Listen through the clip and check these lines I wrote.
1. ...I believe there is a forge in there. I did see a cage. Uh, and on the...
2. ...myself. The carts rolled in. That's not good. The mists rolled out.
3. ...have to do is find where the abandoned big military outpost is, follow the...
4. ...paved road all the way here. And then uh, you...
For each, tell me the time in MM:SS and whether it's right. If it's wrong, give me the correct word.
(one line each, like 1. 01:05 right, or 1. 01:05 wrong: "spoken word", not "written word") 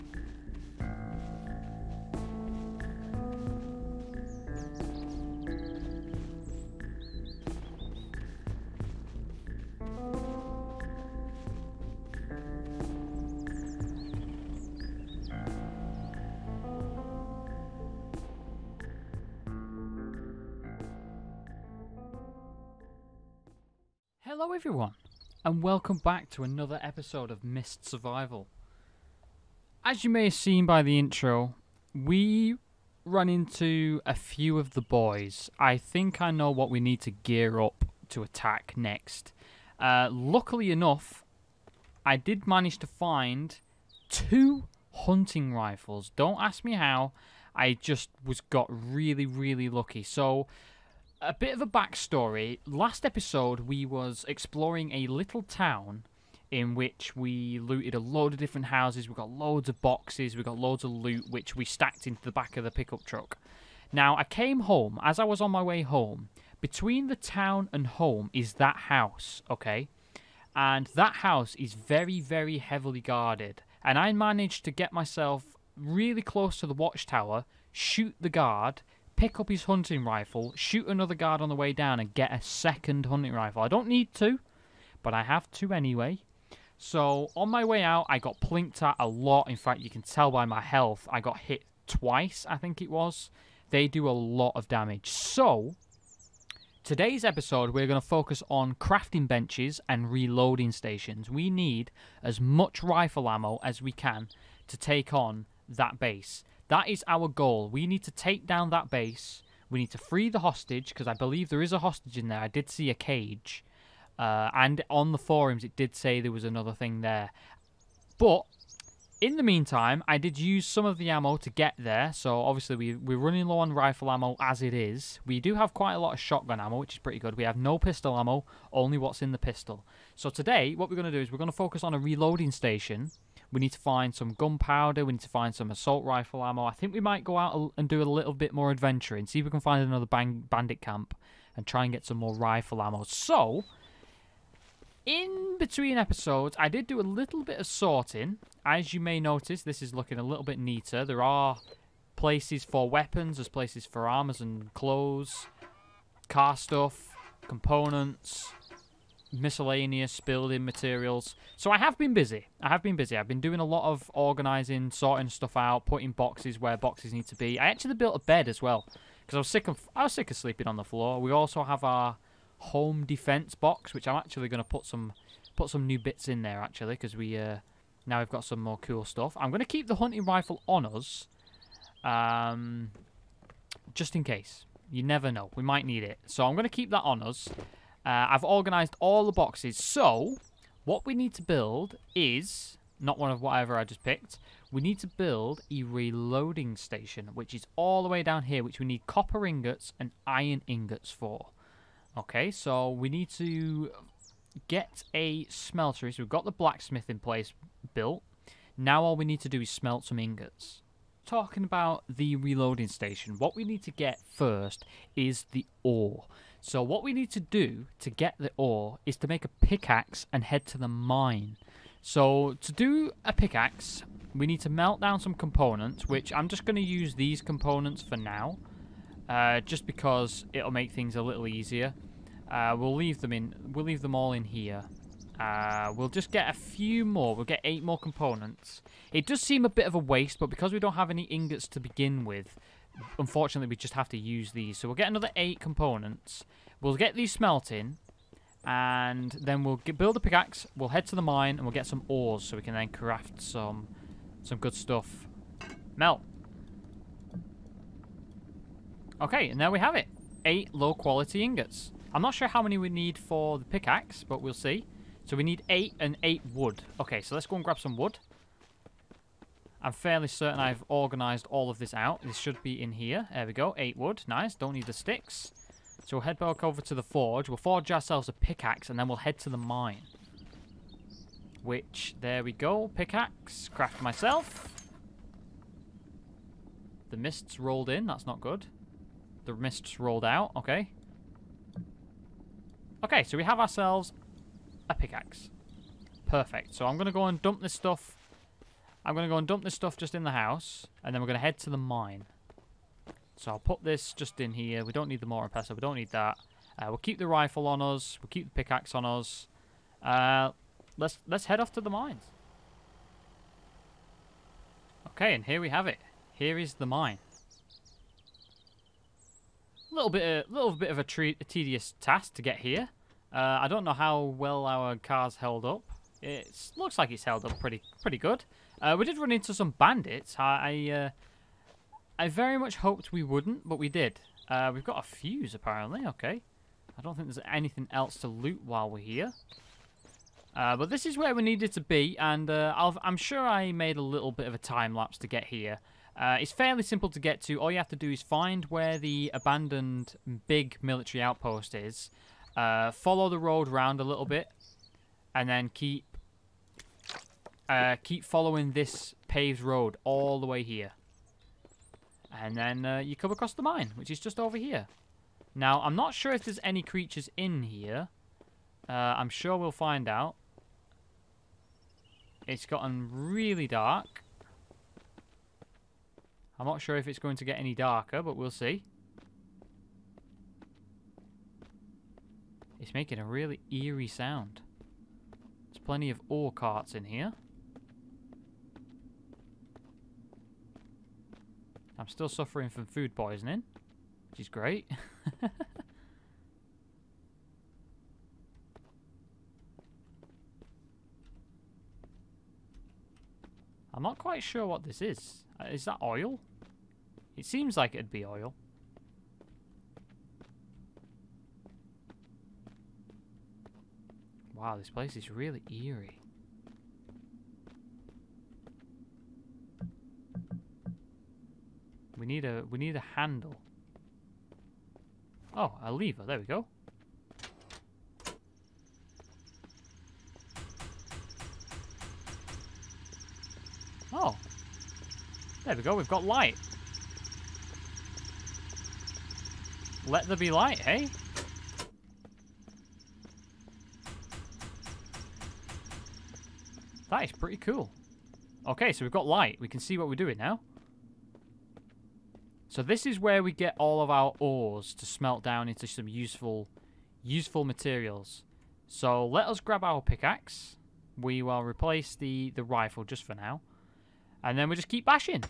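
1. 01:51 wrong: "hostage", not "forge"
2. 04:44 wrong: "mists", not "carts"
3. 05:47 right
4. 05:59 right.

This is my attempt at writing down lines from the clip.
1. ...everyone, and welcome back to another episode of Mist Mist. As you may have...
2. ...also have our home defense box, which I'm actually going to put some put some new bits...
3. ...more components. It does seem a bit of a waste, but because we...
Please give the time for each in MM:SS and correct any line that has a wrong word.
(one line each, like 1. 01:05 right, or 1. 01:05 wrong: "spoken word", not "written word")
1. 00:24 wrong: "Survival", not "Mist"
2. 02:51 right
3. 03:57 right.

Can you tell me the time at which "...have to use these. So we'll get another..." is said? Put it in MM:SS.
04:03.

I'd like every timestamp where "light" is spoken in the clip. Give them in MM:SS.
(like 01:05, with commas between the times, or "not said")
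07:16, 07:20, 07:29.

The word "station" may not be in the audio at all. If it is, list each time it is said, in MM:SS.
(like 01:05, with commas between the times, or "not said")
01:40, 02:12, 03:16, 03:32.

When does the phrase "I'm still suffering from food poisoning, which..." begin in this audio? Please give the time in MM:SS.
06:32.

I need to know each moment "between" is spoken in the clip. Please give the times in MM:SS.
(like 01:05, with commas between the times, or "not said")
01:06, 02:25.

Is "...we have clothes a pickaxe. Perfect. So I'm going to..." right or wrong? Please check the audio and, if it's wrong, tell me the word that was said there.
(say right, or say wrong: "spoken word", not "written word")
wrong: "ourselves", not "clothes".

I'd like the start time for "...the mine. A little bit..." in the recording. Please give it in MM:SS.
05:16.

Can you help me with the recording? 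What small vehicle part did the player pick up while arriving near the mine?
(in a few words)
A fuse.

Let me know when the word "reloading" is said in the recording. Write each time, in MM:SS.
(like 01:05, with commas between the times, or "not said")
01:40, 02:11, 03:15, 03:32.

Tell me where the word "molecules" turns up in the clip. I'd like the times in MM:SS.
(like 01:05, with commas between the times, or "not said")
not said.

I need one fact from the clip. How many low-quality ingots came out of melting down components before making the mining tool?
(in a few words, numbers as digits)
8.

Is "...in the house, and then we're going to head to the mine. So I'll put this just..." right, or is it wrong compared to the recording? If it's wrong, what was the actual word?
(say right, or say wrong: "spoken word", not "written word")
right.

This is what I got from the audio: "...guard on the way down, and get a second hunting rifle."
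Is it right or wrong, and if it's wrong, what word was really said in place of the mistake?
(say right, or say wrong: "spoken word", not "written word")
right.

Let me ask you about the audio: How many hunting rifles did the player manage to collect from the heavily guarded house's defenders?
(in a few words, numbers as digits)
2.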